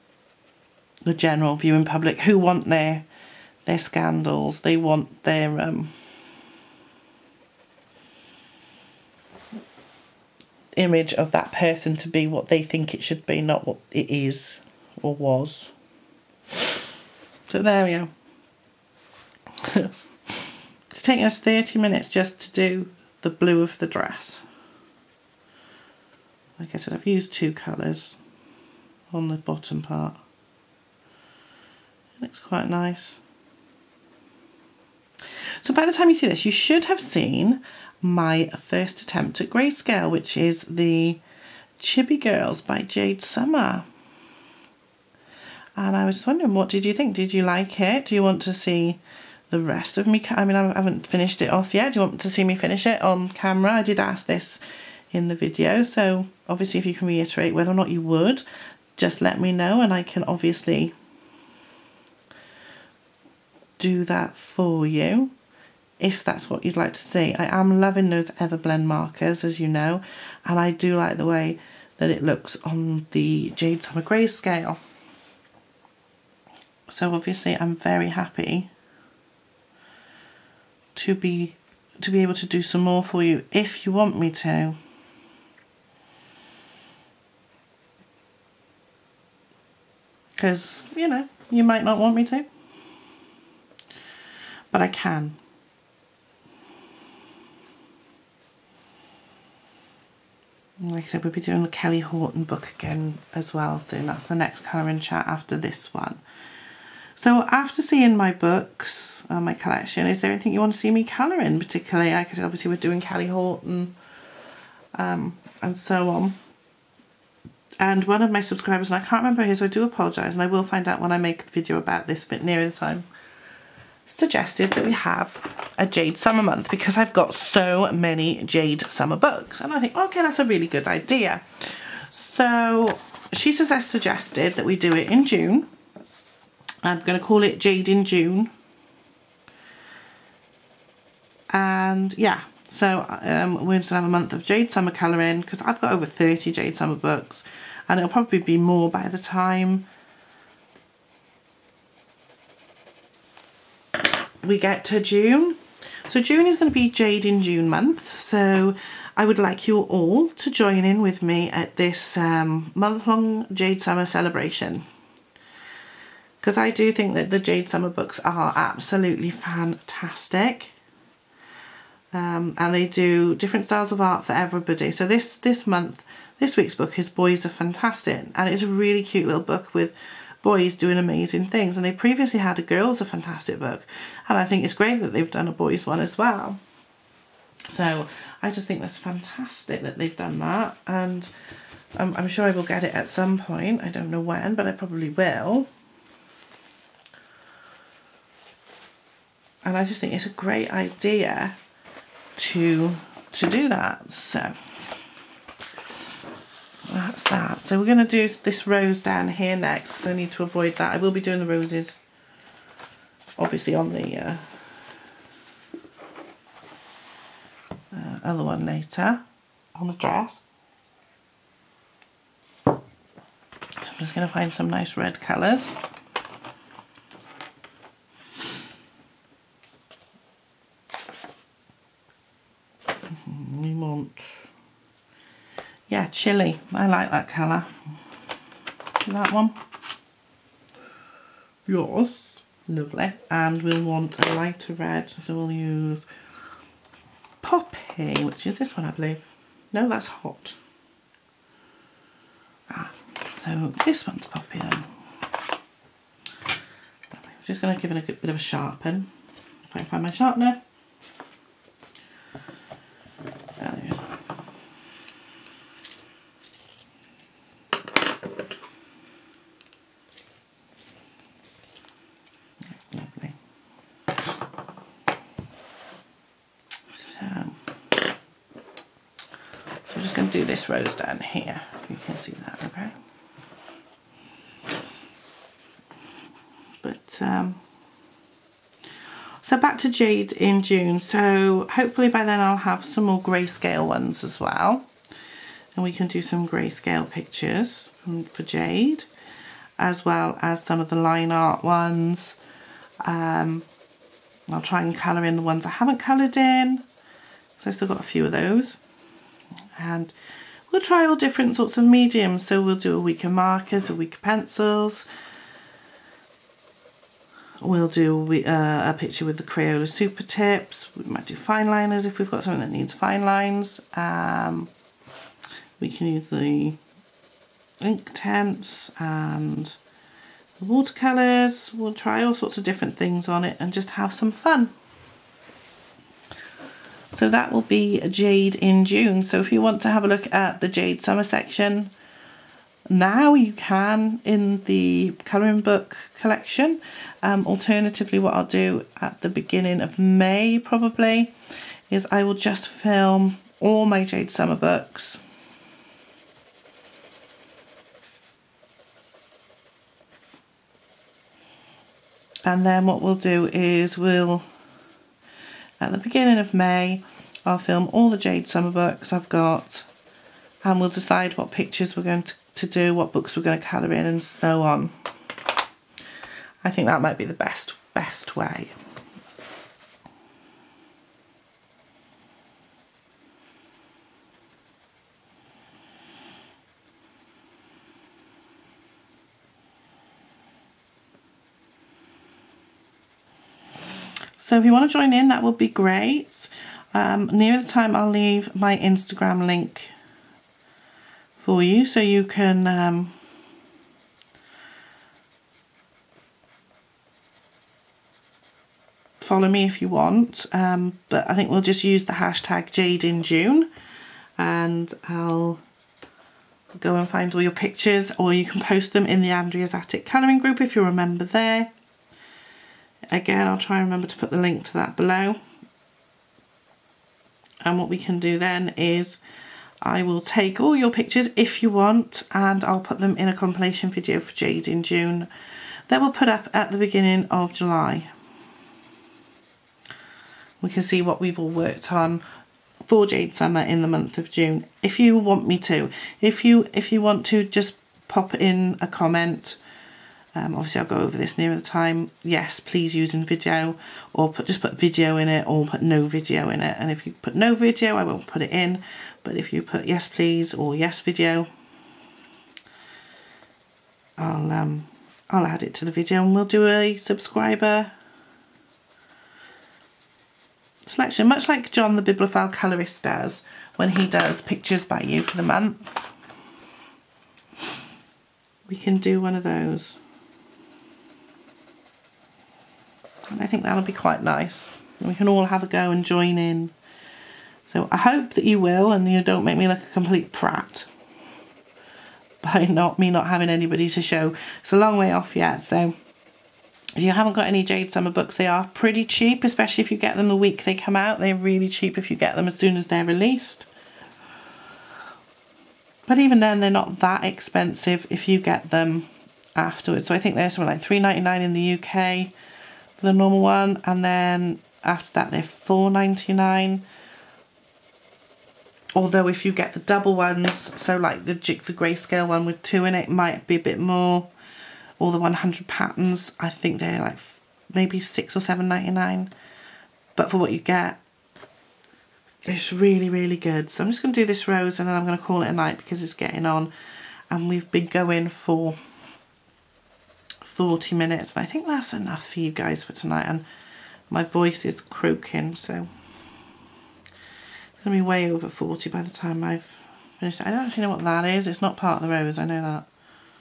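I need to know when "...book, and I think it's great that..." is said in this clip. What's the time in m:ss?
3:03.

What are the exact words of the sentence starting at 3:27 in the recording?
So we're going to do this rose down here next because I need to avoid that.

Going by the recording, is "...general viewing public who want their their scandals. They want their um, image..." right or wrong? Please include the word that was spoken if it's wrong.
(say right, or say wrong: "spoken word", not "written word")
right.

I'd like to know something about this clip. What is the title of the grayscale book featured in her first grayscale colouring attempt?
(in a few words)
Chibi Girls.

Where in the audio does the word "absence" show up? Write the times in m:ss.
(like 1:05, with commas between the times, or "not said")
not said.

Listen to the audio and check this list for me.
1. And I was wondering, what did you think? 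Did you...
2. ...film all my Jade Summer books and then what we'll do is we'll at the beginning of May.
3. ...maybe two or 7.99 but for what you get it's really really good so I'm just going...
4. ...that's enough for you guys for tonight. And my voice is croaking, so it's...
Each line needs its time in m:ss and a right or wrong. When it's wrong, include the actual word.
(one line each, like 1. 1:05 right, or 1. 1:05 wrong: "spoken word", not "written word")
1. 0:45 right
2. 5:52 right
3. 8:47 wrong: "six", not "two"
4. 9:01 right.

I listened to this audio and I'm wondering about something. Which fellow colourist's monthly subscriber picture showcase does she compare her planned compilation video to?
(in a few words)
John the Bibliophile Colorist.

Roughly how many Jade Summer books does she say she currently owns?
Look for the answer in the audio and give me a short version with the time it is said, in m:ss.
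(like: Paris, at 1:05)
over 30, at 2:25.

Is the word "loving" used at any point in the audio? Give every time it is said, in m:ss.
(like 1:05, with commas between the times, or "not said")
1:07.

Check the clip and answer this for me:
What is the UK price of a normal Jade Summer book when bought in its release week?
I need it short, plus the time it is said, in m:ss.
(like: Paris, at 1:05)
£3.99, at 8:30.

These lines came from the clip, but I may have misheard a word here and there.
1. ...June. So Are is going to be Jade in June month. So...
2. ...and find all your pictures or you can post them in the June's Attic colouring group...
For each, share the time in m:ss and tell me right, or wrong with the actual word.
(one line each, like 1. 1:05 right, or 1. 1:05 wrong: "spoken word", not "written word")
1. 2:34 wrong: "June", not "Are"
2. 6:56 wrong: "Andrea", not "June".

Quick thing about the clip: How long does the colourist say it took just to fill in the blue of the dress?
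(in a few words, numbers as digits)
30 minutes.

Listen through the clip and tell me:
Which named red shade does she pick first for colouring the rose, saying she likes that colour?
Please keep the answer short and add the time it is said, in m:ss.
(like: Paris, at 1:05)
Chili, at 3:56.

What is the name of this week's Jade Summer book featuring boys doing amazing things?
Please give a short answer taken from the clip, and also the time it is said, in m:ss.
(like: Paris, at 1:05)
Boys Are Fantastic, at 2:57.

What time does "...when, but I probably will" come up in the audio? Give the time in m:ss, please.
3:14.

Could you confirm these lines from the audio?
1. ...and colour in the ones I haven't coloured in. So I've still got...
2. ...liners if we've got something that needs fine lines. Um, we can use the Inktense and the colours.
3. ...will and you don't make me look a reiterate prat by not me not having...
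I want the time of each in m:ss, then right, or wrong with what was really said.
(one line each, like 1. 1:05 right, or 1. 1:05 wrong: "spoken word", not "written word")
1. 5:04 right
2. 5:21 wrong: "watercolours", not "colours"
3. 8:08 wrong: "complete", not "reiterate".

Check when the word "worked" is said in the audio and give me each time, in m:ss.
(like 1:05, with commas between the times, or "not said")
7:21.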